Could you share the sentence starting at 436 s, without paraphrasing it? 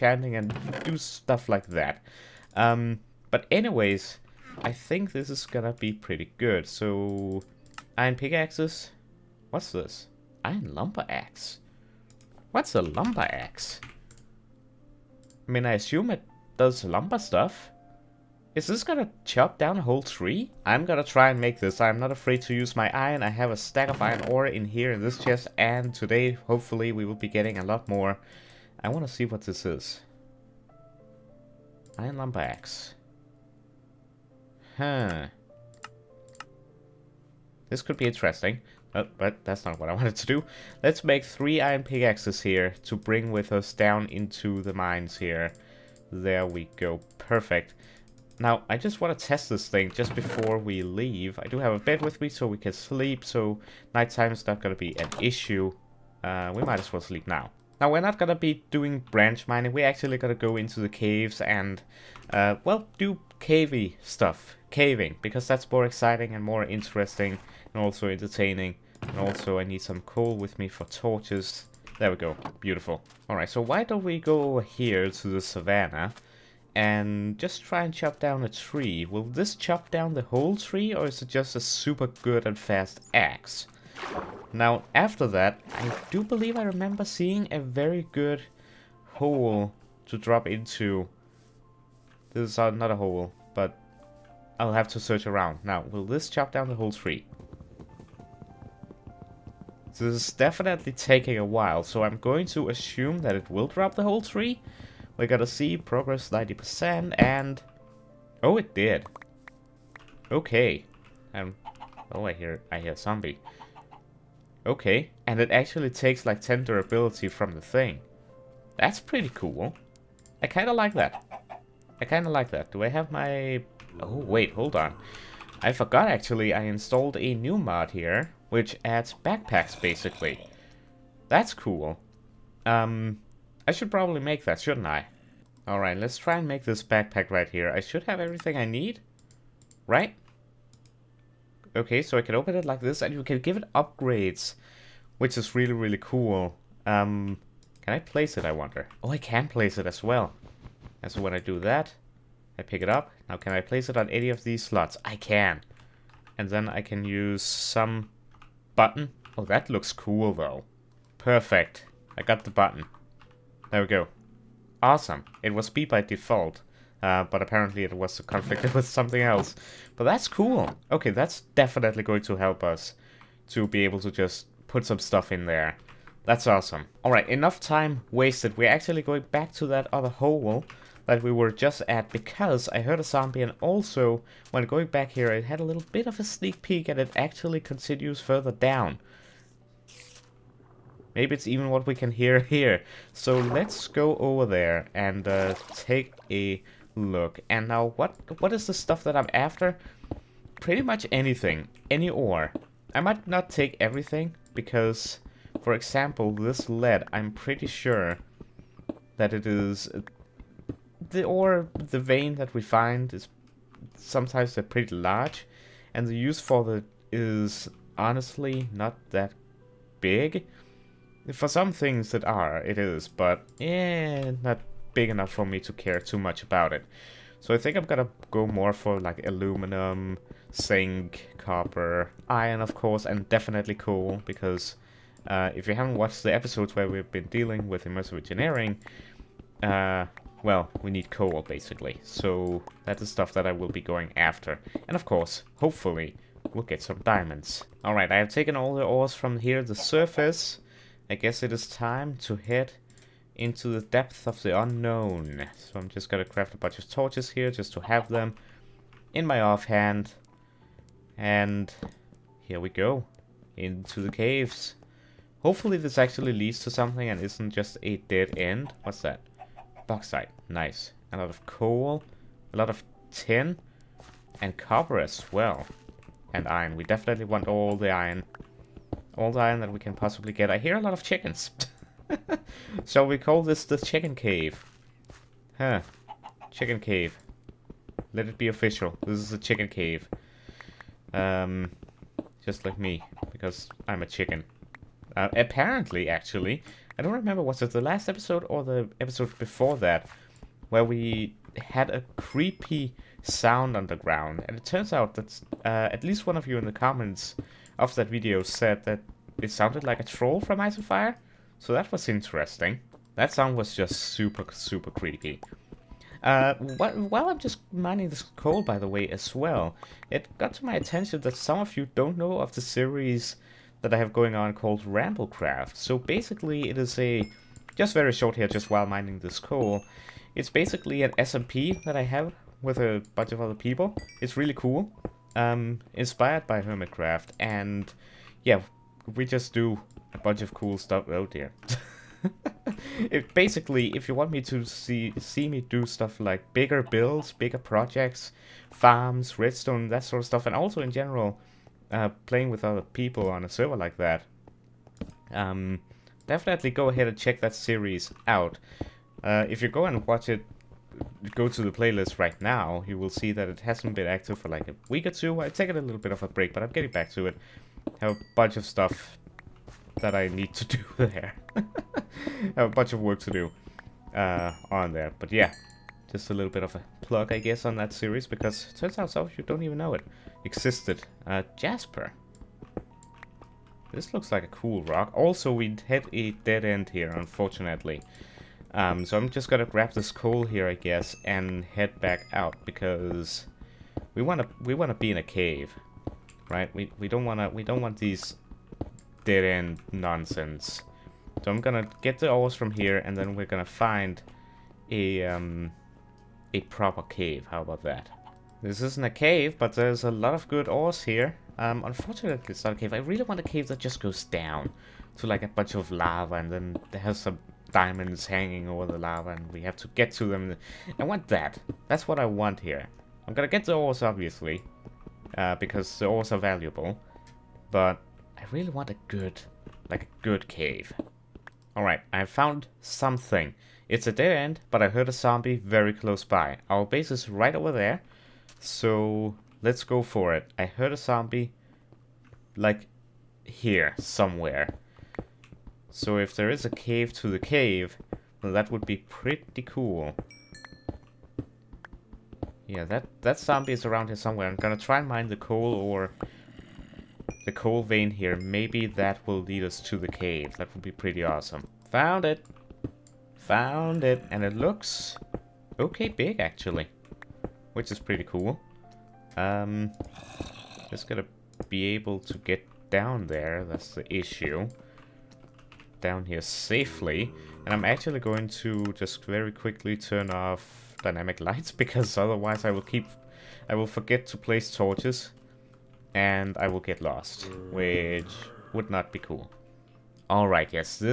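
Our base is right over there, so let's go for it.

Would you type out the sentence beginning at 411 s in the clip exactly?
Um, unfortunately, it's not a cave.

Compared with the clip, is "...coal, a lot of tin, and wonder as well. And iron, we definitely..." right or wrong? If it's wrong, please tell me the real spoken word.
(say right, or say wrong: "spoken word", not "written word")
wrong: "copper", not "wonder".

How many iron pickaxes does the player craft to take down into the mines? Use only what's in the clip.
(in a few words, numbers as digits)
3.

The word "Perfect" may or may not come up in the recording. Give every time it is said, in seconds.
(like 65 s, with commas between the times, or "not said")
47 s, 161 s.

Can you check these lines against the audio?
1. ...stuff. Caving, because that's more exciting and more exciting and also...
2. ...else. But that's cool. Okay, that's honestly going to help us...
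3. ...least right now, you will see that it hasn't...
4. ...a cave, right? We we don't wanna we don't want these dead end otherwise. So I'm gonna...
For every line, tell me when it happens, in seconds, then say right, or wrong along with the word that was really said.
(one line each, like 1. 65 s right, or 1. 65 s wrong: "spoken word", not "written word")
1. 64 s wrong: "interesting", not "exciting"
2. 169 s wrong: "definitely", not "honestly"
3. 361 s wrong: "playlist", not "least"
4. 395 s wrong: "nonsense", not "otherwise".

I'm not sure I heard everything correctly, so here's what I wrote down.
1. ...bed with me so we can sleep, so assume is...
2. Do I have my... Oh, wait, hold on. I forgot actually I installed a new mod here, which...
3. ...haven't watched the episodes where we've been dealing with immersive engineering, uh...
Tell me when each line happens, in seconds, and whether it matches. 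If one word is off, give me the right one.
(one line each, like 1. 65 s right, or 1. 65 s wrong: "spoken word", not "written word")
1. 51 s wrong: "nighttime", not "assume"
2. 122 s right
3. 235 s right.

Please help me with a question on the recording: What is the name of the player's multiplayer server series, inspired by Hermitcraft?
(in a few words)
Ramblecraft.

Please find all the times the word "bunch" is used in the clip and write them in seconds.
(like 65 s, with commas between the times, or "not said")
256 s, 333 s, 340 s, 368 s, 372 s, 415 s.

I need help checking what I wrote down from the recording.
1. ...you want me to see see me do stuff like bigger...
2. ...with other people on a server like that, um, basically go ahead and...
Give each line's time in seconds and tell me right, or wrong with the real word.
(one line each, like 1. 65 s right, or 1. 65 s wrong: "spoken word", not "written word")
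1. 344 s right
2. 352 s wrong: "definitely", not "basically".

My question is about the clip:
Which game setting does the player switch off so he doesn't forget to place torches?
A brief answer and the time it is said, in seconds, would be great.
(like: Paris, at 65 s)
dynamic lights, at 481 s.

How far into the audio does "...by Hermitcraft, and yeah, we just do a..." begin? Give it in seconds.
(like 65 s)
336 s.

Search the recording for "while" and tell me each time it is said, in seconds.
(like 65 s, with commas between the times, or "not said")
101 s, 316 s, 328 s.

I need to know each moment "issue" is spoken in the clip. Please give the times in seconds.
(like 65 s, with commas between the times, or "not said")
55 s, 474 s.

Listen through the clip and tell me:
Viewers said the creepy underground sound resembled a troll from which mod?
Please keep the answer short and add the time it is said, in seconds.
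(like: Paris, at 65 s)
Ice and Fire, at 310 s.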